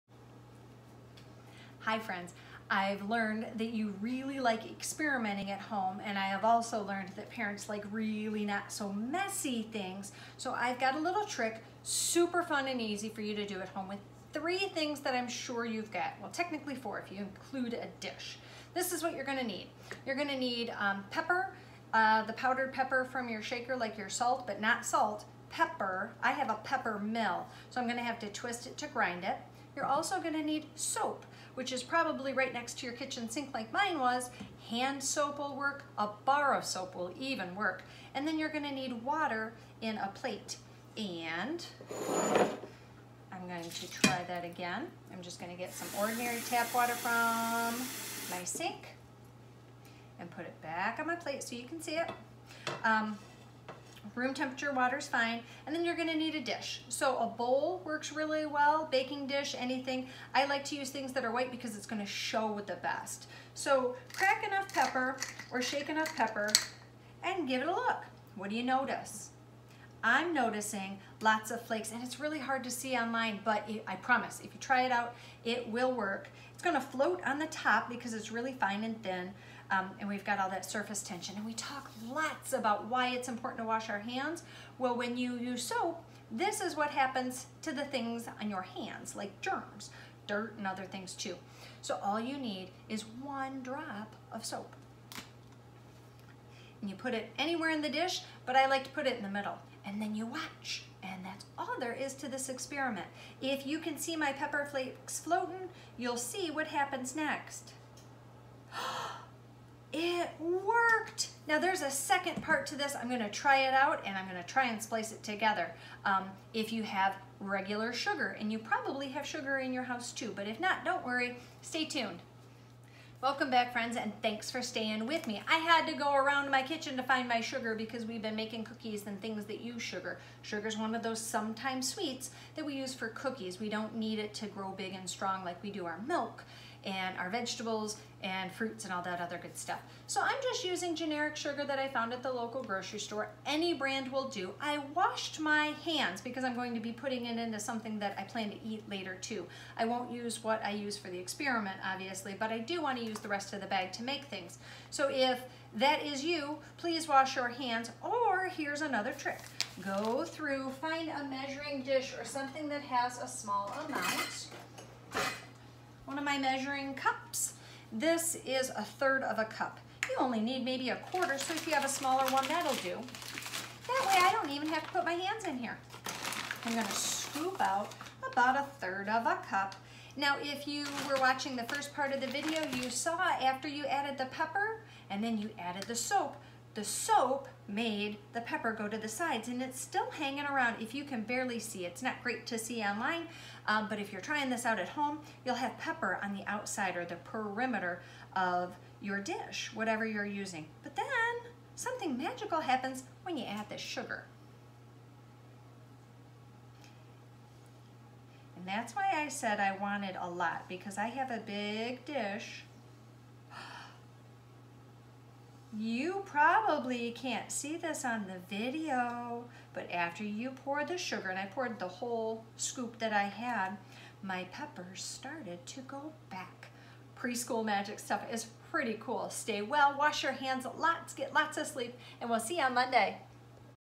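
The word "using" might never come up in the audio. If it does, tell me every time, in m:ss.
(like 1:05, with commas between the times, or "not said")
2:20, 3:20.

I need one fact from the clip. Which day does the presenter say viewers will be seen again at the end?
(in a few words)
Monday.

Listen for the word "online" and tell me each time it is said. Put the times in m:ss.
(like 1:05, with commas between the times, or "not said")
1:12, 3:12.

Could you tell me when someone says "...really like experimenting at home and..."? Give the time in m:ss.
0:03.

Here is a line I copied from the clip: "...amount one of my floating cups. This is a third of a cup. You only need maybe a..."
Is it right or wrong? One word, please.
wrong.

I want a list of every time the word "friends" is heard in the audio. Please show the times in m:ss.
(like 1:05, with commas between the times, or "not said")
0:01, 2:03.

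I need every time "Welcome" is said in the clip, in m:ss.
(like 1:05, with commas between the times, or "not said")
2:03.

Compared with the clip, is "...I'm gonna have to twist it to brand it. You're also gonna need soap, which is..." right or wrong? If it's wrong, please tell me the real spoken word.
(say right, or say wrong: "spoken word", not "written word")
wrong: "grind", not "brand".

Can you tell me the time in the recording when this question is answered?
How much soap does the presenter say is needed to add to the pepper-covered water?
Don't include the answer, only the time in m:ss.
1:33.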